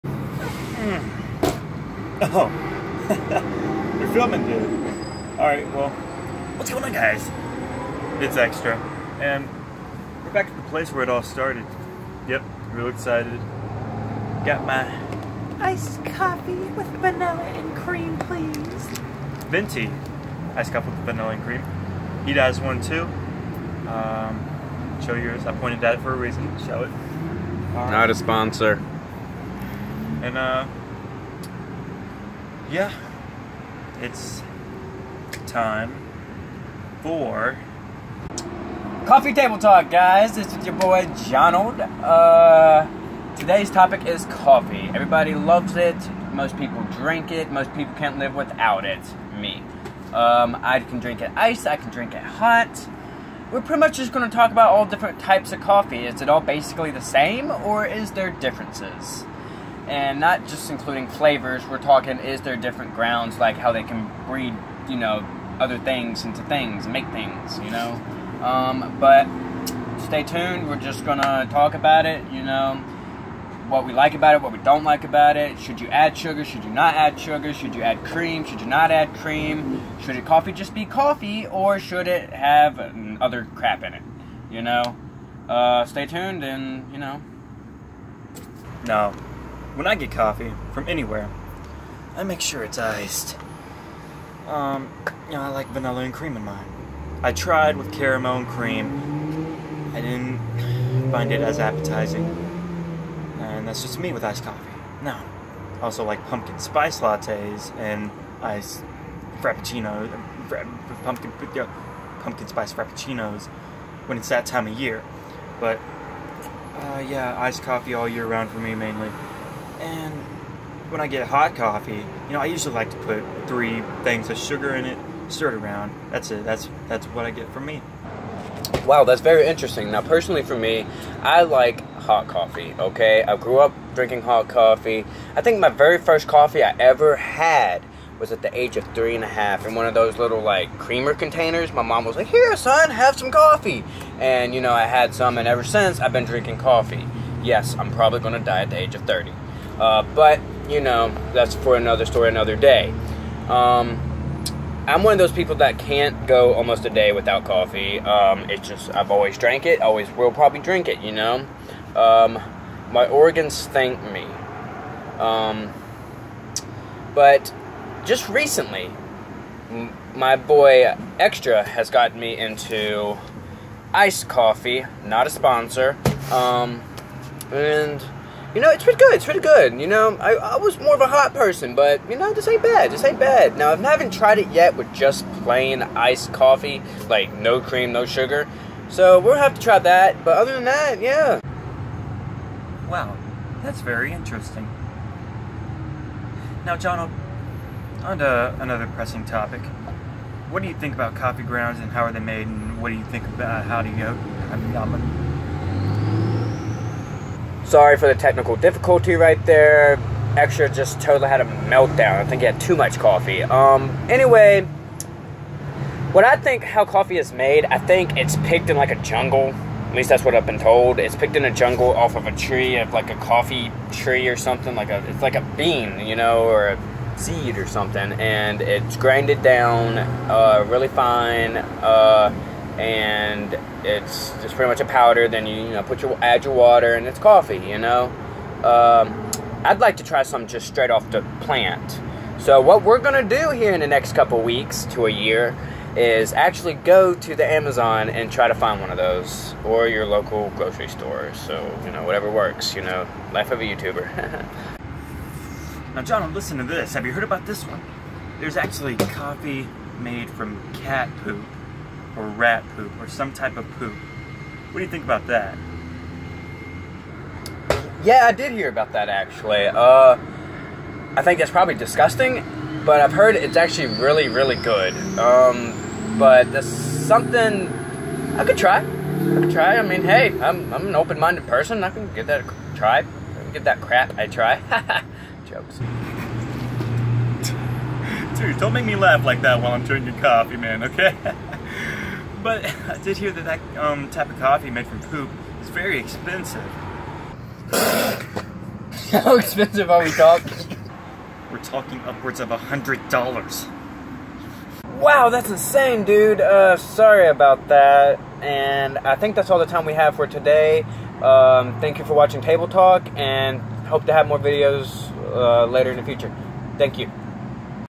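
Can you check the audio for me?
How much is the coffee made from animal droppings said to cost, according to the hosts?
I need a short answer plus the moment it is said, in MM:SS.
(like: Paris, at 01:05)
Upwards of $100, at 05:02.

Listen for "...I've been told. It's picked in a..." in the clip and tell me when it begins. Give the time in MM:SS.
03:40.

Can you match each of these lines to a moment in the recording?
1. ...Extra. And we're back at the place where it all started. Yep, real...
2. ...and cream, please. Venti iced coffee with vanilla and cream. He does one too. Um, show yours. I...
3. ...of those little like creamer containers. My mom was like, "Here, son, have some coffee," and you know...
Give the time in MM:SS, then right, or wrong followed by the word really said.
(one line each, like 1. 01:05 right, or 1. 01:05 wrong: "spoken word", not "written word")
1. 00:08 right
2. 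00:17 right
3. 02:19 right.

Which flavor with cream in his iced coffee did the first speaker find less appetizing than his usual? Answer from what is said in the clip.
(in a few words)
Caramel.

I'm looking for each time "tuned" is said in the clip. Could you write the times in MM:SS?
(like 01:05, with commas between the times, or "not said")
01:10, 01:26.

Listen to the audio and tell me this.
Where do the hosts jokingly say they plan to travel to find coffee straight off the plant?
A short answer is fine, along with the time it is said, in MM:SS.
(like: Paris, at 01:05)
The Amazon, at 04:07.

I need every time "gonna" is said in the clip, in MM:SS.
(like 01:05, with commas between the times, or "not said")
01:11, 02:28, 04:02.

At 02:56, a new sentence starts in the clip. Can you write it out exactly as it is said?
Um, and you know, it's pretty good.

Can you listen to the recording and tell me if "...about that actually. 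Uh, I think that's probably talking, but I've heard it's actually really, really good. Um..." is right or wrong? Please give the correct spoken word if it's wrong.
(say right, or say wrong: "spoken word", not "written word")
wrong: "disgusting", not "talking".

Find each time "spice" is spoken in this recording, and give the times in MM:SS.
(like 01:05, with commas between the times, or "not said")
01:46, 01:52.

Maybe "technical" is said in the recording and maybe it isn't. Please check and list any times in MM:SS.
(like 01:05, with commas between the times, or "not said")
03:28.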